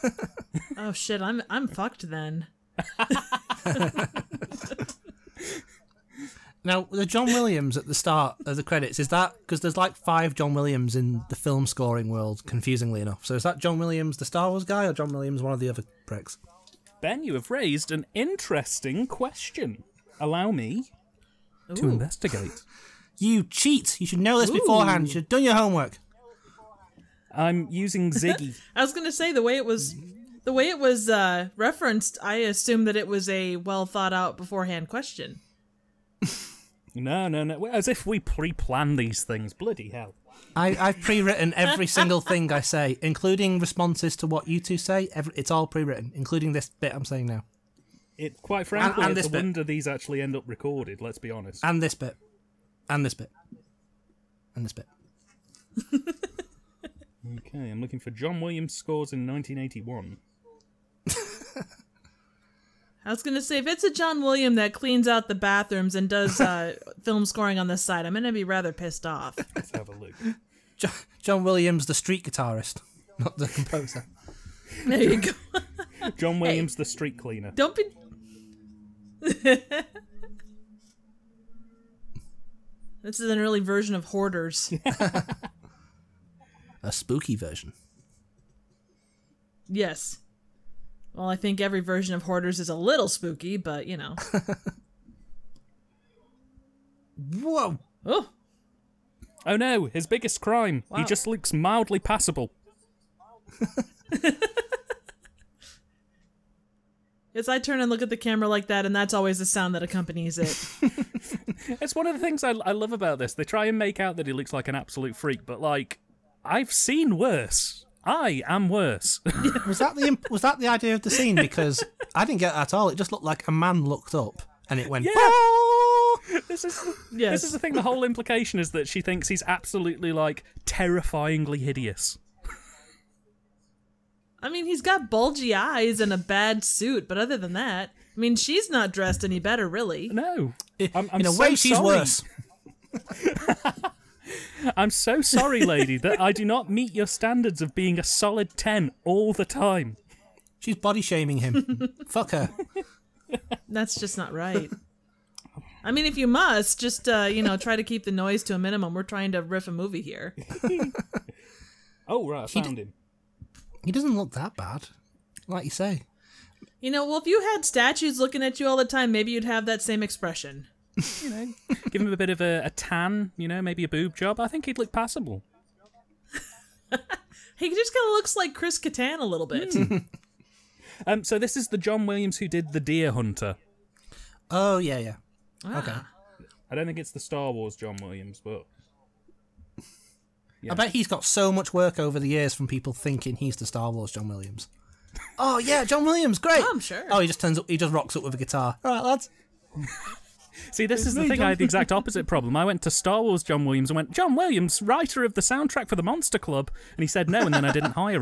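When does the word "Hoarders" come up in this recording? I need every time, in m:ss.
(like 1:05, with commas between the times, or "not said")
1:24, 1:32.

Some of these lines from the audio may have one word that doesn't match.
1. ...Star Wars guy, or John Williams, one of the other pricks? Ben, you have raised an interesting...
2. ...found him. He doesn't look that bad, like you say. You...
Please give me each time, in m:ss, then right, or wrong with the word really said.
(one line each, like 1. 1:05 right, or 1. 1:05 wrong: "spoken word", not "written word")
1. 0:14 right
2. 2:42 right.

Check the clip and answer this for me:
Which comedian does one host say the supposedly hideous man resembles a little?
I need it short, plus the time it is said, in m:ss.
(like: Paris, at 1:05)
Chris Kattan, at 2:58.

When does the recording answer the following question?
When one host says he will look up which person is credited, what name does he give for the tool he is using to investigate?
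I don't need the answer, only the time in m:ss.
0:28.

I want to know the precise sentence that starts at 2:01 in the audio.
Because I didn't get that at all.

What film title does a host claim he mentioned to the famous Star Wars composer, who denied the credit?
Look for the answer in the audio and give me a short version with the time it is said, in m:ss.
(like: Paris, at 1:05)
The Monster Club, at 3:25.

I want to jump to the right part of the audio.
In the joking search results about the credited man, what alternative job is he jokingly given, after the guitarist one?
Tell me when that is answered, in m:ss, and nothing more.
1:16.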